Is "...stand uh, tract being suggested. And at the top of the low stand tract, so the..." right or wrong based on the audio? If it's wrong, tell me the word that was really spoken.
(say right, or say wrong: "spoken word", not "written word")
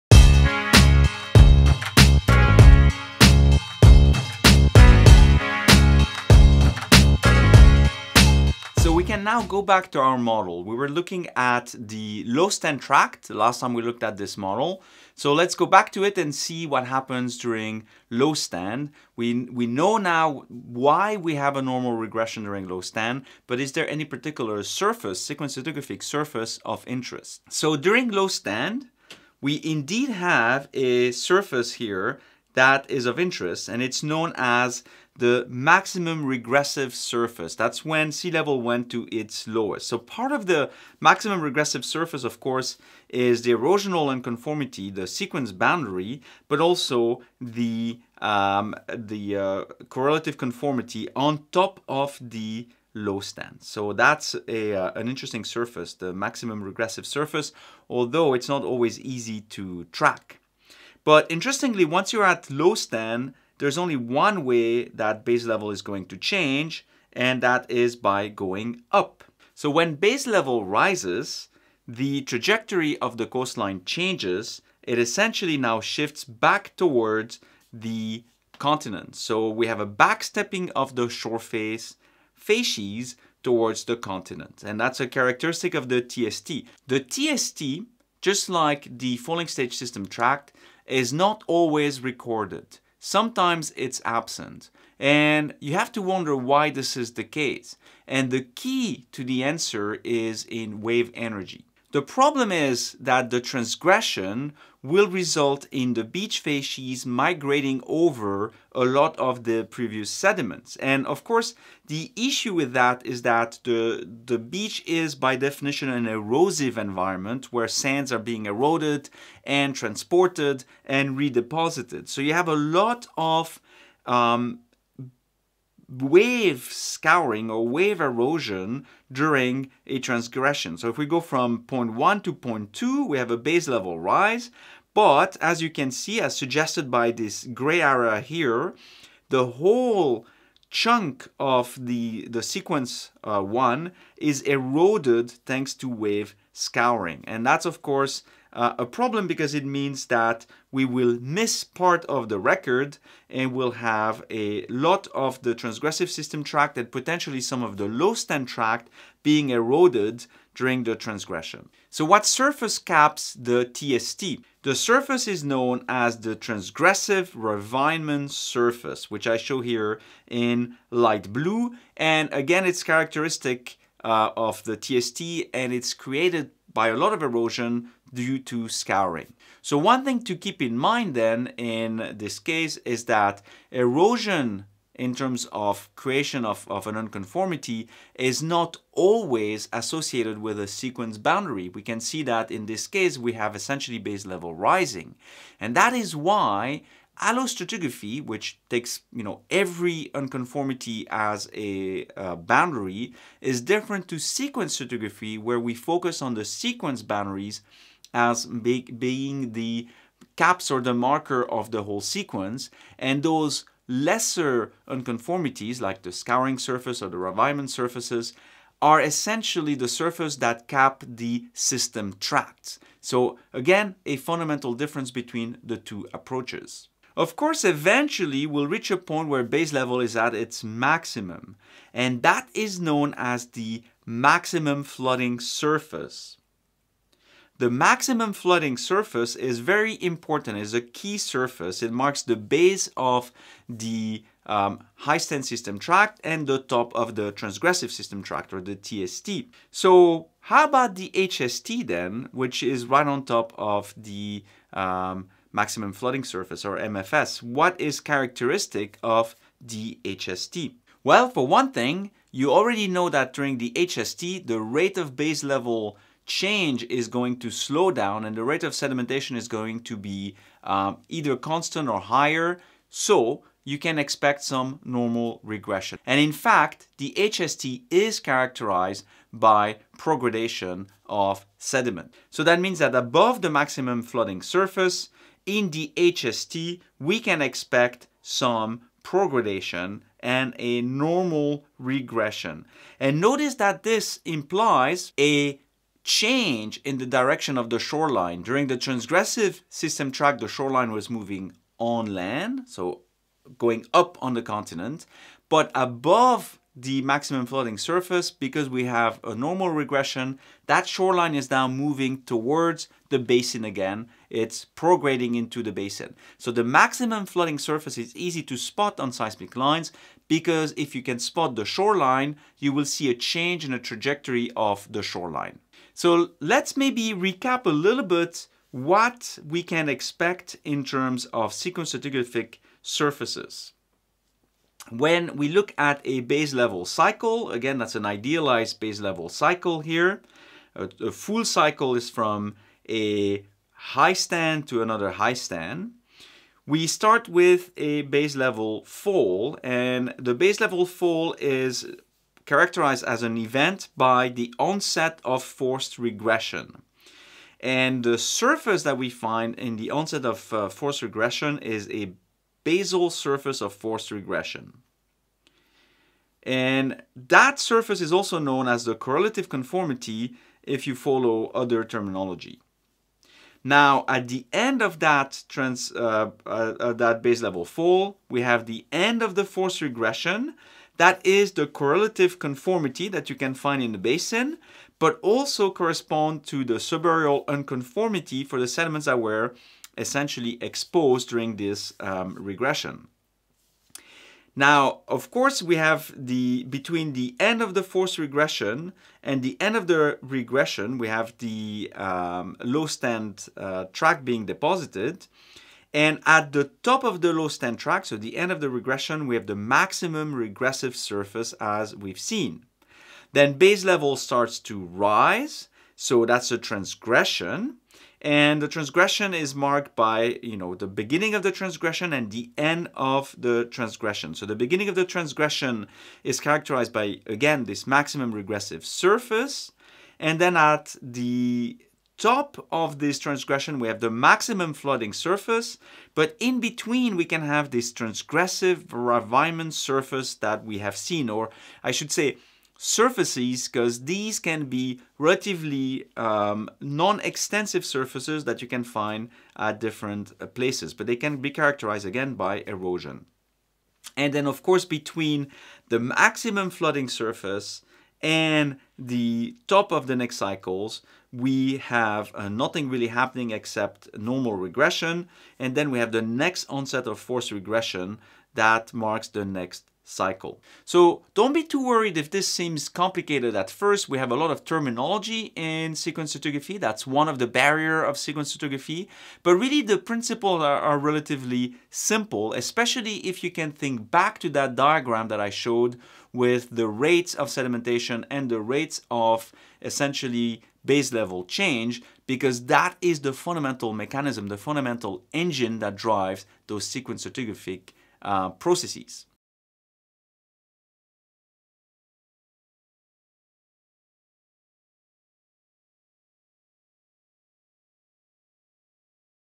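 wrong: "deposited", not "suggested".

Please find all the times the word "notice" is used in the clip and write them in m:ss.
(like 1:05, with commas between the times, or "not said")
4:53.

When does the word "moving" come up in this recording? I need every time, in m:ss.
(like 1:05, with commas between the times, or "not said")
5:01, 5:11.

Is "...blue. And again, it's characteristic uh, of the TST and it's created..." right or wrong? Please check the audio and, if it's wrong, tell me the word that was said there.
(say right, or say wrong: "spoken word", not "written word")
right.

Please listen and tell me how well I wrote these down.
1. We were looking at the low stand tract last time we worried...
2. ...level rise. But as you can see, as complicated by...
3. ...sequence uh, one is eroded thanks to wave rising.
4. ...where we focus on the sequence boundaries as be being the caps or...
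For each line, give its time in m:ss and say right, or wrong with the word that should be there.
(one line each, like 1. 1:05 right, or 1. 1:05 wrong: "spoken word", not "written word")
1. 0:10 wrong: "looked", not "worried"
2. 2:13 wrong: "suggested", not "complicated"
3. 2:22 wrong: "scouring", not "rising"
4. 3:25 right.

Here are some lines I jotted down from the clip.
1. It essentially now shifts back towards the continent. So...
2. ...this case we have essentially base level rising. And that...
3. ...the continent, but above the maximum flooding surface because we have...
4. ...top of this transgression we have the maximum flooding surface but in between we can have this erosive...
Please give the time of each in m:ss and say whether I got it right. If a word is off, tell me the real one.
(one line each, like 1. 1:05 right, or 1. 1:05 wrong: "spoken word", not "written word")
1. 1:14 right
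2. 3:12 right
3. 5:04 right
4. 7:12 wrong: "transgressive", not "erosive".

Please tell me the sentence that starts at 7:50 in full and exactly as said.
So don't be too worried if this seems complicated at first.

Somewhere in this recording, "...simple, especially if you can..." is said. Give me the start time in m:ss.
8:01.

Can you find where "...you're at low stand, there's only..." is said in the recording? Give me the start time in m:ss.
1:02.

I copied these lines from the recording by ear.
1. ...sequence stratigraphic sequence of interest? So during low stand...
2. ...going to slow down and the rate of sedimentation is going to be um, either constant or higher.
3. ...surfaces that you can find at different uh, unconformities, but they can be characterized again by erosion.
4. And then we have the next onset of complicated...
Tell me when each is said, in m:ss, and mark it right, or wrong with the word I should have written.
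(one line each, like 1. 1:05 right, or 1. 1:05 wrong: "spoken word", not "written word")
1. 0:25 wrong: "surface", not "sequence"
2. 4:27 right
3. 7:27 wrong: "places", not "unconformities"
4. 7:45 wrong: "forced", not "complicated".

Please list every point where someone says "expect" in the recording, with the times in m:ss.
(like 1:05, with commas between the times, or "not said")
4:33, 4:47, 5:29.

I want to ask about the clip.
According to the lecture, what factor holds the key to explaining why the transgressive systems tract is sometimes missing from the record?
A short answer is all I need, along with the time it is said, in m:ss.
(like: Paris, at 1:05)
wave energy, at 1:40.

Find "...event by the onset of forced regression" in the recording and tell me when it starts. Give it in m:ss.
5:53.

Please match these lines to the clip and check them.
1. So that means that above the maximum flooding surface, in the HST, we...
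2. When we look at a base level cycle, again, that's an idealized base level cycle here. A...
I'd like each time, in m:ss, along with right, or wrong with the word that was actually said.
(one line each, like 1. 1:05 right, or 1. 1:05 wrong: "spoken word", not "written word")
1. 4:42 right
2. 5:34 right.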